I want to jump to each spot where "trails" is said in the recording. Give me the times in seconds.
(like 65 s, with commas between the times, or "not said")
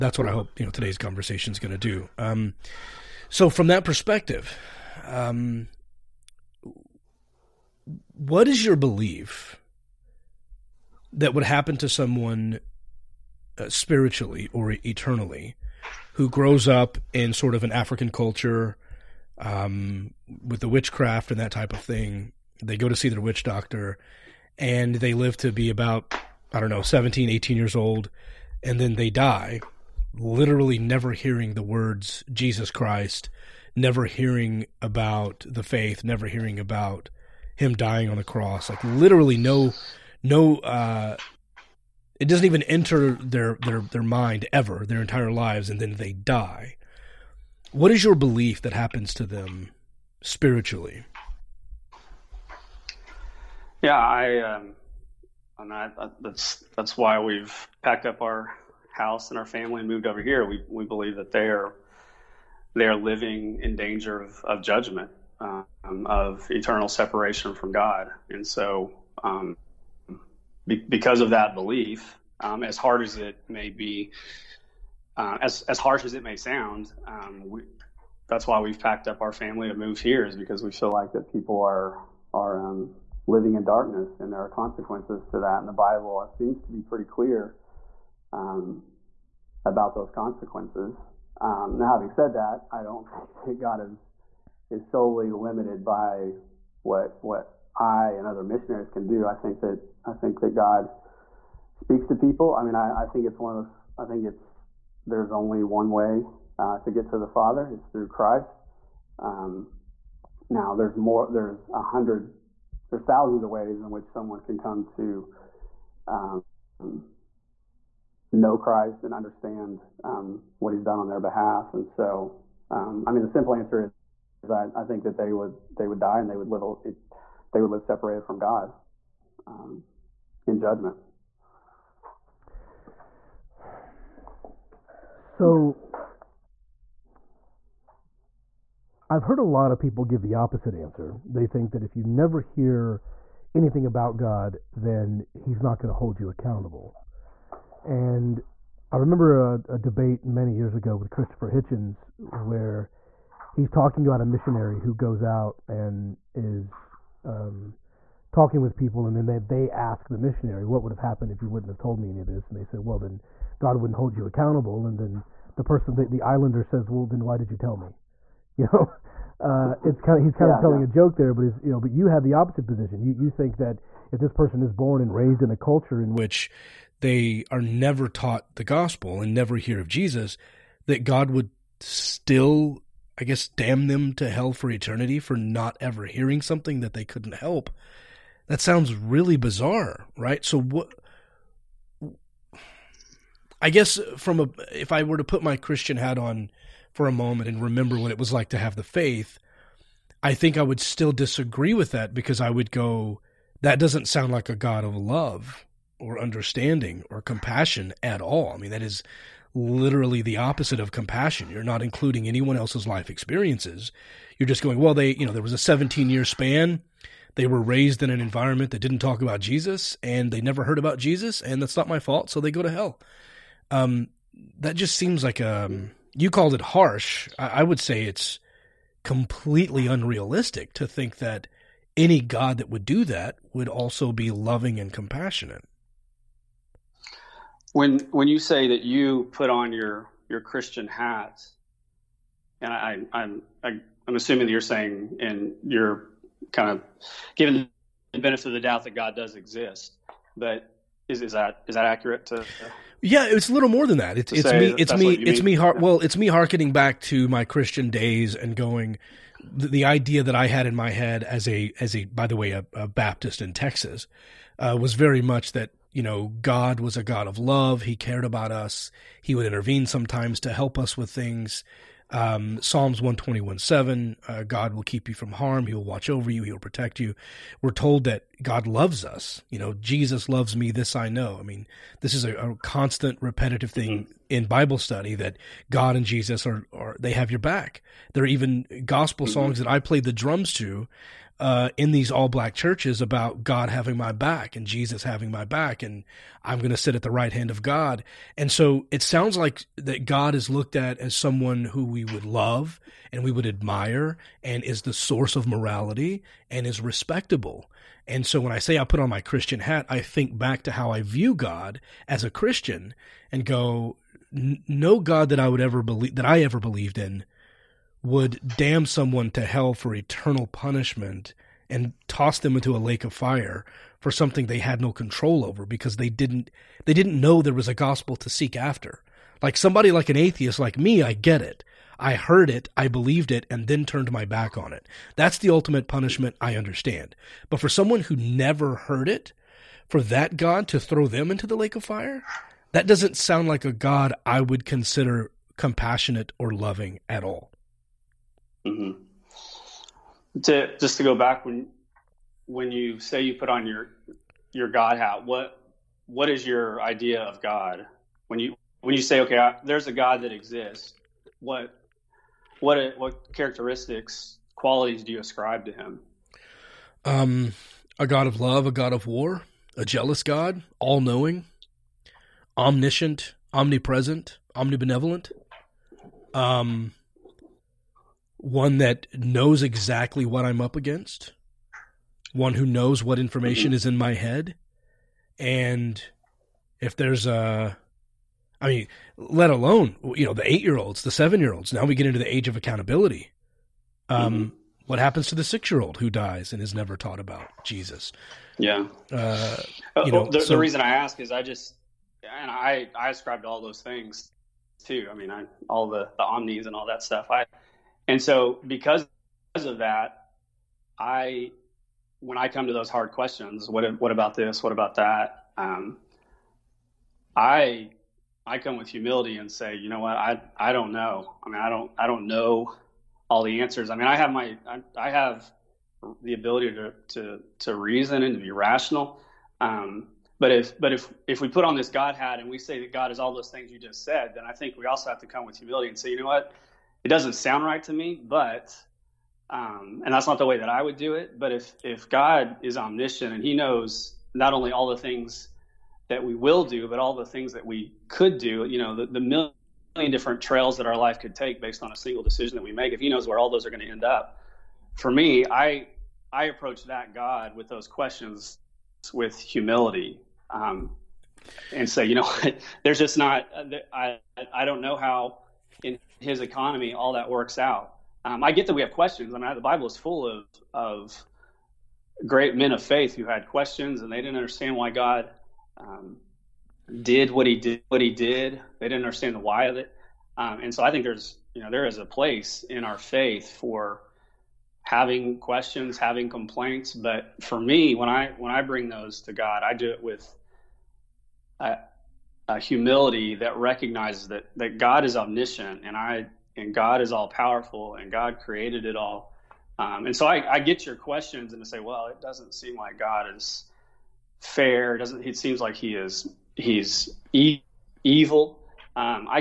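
450 s.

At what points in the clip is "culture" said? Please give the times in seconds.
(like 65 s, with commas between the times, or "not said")
18 s, 175 s.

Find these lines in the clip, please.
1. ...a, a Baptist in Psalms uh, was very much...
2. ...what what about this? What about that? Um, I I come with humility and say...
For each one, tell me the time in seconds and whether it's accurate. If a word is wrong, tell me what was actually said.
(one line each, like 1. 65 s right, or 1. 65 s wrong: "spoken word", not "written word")
1. 262 s wrong: "Texas", not "Psalms"
2. 413 s right.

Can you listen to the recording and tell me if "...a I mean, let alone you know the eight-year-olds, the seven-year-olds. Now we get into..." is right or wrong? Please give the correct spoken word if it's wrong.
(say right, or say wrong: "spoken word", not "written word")
right.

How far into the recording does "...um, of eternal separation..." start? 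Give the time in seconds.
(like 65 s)
65 s.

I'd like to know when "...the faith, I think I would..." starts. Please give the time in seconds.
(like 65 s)
198 s.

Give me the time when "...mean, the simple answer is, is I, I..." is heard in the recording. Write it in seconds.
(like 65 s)
123 s.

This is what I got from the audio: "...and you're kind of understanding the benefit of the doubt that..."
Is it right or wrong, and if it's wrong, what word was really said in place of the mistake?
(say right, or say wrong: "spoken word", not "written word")
wrong: "giving", not "understanding".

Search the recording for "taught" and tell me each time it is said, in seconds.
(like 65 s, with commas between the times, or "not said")
178 s, 396 s.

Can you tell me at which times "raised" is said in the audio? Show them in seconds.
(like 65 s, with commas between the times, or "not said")
175 s, 217 s.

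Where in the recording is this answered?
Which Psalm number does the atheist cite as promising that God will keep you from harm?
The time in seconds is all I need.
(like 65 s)
272 s.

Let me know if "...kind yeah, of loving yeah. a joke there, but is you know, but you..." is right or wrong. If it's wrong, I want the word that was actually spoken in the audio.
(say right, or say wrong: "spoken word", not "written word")
wrong: "telling", not "loving".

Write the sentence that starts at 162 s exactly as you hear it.
And they said, Well, then God wouldn't hold you accountable.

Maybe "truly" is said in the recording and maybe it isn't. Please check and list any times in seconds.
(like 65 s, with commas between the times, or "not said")
not said.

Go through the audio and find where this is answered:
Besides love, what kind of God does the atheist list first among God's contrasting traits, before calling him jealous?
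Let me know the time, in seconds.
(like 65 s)
368 s.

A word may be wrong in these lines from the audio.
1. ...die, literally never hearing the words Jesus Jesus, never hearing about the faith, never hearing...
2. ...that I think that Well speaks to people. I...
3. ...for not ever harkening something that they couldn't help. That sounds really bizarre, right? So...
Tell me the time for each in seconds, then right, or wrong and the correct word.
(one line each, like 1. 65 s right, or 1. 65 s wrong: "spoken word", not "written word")
1. 29 s wrong: "Christ", not "Jesus"
2. 99 s wrong: "God", not "Well"
3. 185 s wrong: "hearing", not "harkening".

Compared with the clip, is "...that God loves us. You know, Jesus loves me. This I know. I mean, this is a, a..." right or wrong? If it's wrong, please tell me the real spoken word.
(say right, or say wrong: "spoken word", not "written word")
right.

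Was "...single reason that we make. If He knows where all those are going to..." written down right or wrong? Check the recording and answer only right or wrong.
wrong.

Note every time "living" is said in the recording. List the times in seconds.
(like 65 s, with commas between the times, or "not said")
62 s, 83 s.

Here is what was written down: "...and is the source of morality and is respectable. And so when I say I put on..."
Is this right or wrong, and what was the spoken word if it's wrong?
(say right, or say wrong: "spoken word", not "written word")
right.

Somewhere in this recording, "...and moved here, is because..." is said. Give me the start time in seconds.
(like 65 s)
79 s.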